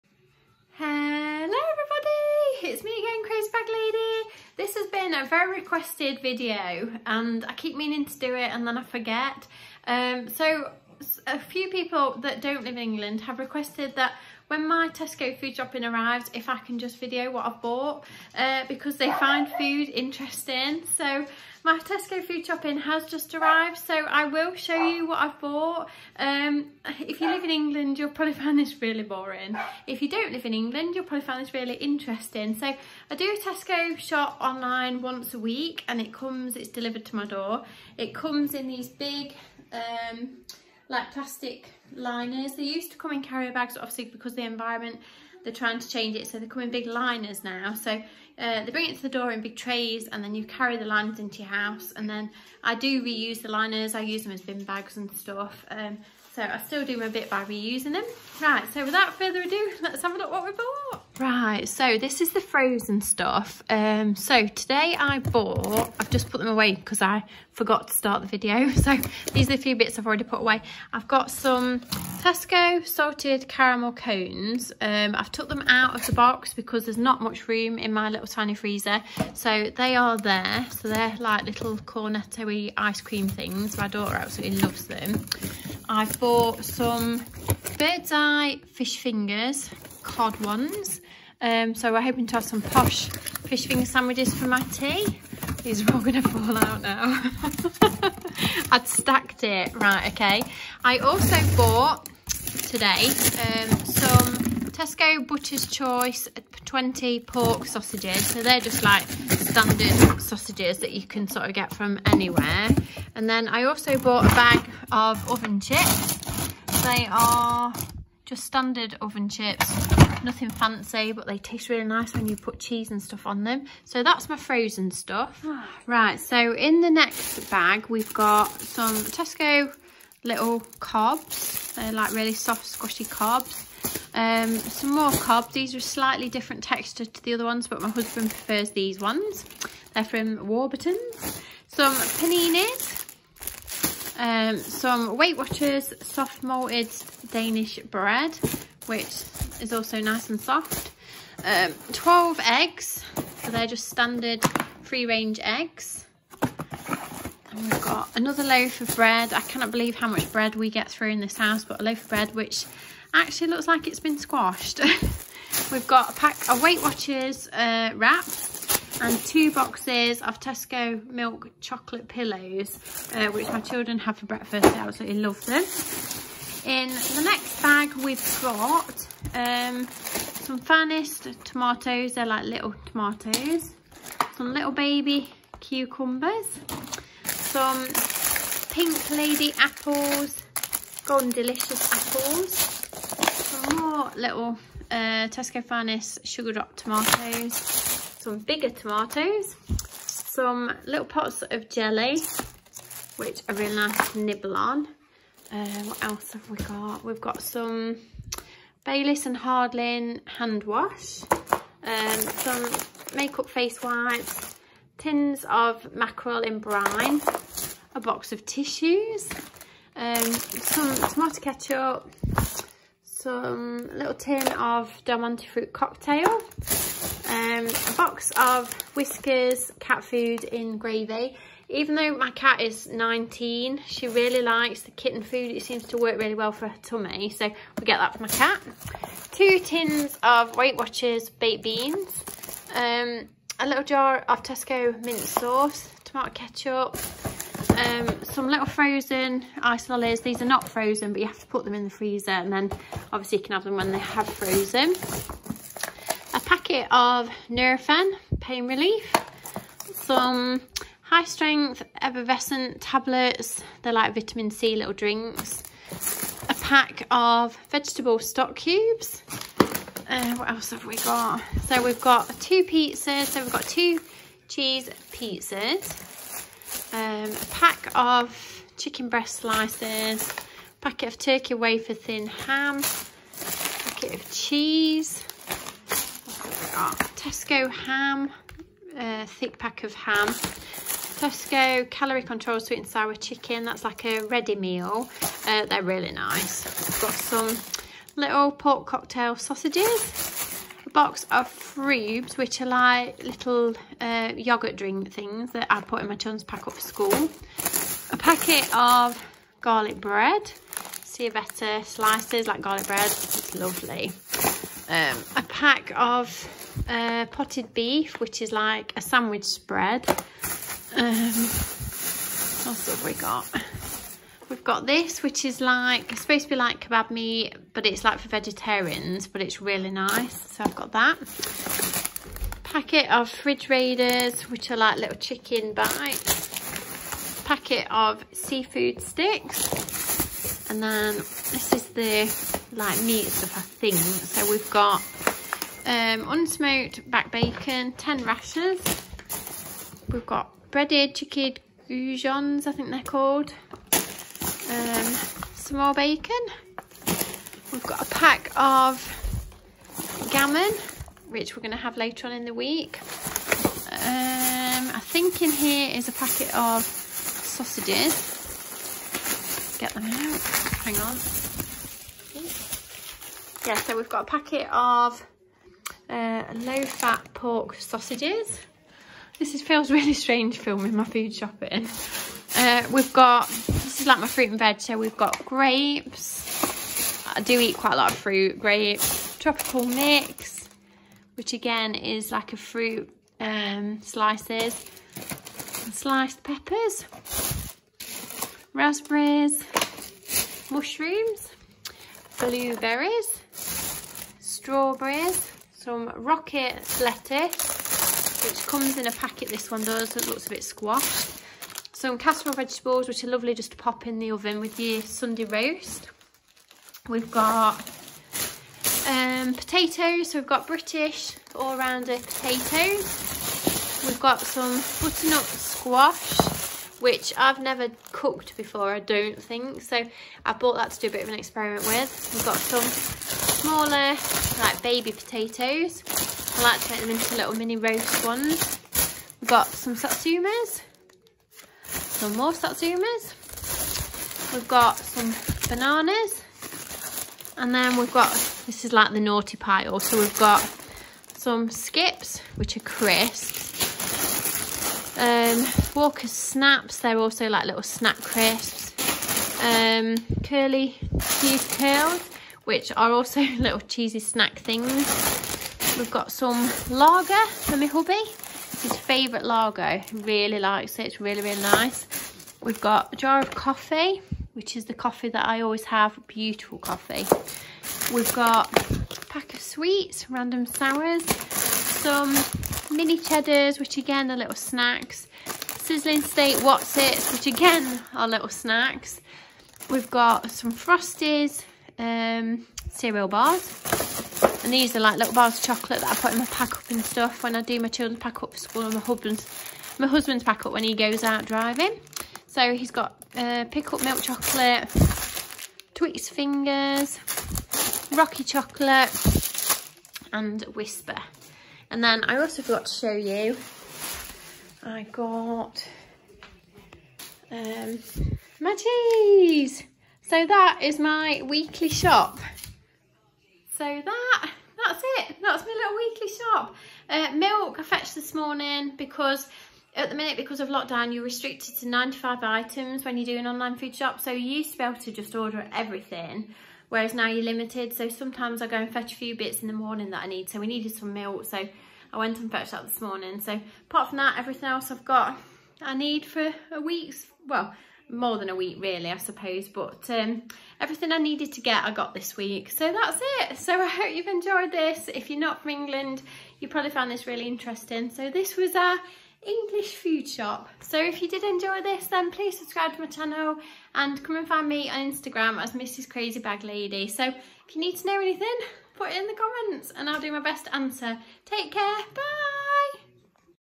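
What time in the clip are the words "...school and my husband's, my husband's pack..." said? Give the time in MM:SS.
08:18.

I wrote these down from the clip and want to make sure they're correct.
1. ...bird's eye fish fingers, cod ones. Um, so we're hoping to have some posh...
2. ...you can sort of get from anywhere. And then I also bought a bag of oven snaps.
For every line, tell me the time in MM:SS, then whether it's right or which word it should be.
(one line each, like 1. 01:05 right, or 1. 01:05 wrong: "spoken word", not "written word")
1. 01:27 right
2. 01:50 wrong: "chips", not "snaps".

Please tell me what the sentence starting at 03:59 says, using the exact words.
Two tins of Weight Watchers baked beans.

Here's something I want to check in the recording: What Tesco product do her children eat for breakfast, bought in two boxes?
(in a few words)
milk chocolate pillows.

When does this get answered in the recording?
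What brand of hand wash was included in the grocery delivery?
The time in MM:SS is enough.
03:28.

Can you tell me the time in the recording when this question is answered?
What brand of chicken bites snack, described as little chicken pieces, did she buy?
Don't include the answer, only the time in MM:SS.
05:33.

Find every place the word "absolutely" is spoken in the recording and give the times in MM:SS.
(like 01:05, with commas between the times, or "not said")
01:24, 02:54.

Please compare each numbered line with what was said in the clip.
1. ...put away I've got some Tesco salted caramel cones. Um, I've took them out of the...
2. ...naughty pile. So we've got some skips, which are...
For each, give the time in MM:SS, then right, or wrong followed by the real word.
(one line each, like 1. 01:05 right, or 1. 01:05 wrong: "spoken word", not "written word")
1. 01:10 right
2. 07:29 right.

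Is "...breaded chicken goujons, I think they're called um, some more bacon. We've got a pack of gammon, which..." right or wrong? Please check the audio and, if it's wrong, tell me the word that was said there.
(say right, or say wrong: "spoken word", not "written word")
right.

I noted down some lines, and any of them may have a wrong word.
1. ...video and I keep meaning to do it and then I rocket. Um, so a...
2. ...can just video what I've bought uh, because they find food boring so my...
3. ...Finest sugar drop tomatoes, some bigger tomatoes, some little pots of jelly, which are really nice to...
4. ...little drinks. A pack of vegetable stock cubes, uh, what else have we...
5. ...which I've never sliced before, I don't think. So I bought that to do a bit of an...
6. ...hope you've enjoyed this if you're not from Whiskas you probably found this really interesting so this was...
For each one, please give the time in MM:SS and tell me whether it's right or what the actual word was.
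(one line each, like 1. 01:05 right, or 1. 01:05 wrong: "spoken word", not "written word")
1. 00:06 wrong: "forget", not "rocket"
2. 00:16 wrong: "interesting", not "boring"
3. 03:15 right
4. 04:24 right
5. 07:07 wrong: "cooked", not "sliced"
6. 09:13 wrong: "England", not "Whiskas".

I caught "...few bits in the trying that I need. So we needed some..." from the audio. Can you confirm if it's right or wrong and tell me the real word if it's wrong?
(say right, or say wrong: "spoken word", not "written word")
wrong: "morning", not "trying".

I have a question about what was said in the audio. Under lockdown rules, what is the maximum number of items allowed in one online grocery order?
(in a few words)
95.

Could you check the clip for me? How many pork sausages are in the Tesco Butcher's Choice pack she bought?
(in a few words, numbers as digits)
20.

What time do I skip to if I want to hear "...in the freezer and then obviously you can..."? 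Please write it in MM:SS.
04:11.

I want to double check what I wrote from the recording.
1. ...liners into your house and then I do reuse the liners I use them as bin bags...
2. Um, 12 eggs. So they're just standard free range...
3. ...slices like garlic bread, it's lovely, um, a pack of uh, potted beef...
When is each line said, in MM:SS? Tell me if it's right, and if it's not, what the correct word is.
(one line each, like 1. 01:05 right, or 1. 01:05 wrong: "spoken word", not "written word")
1. 00:50 right
2. 02:31 right
3. 05:11 right.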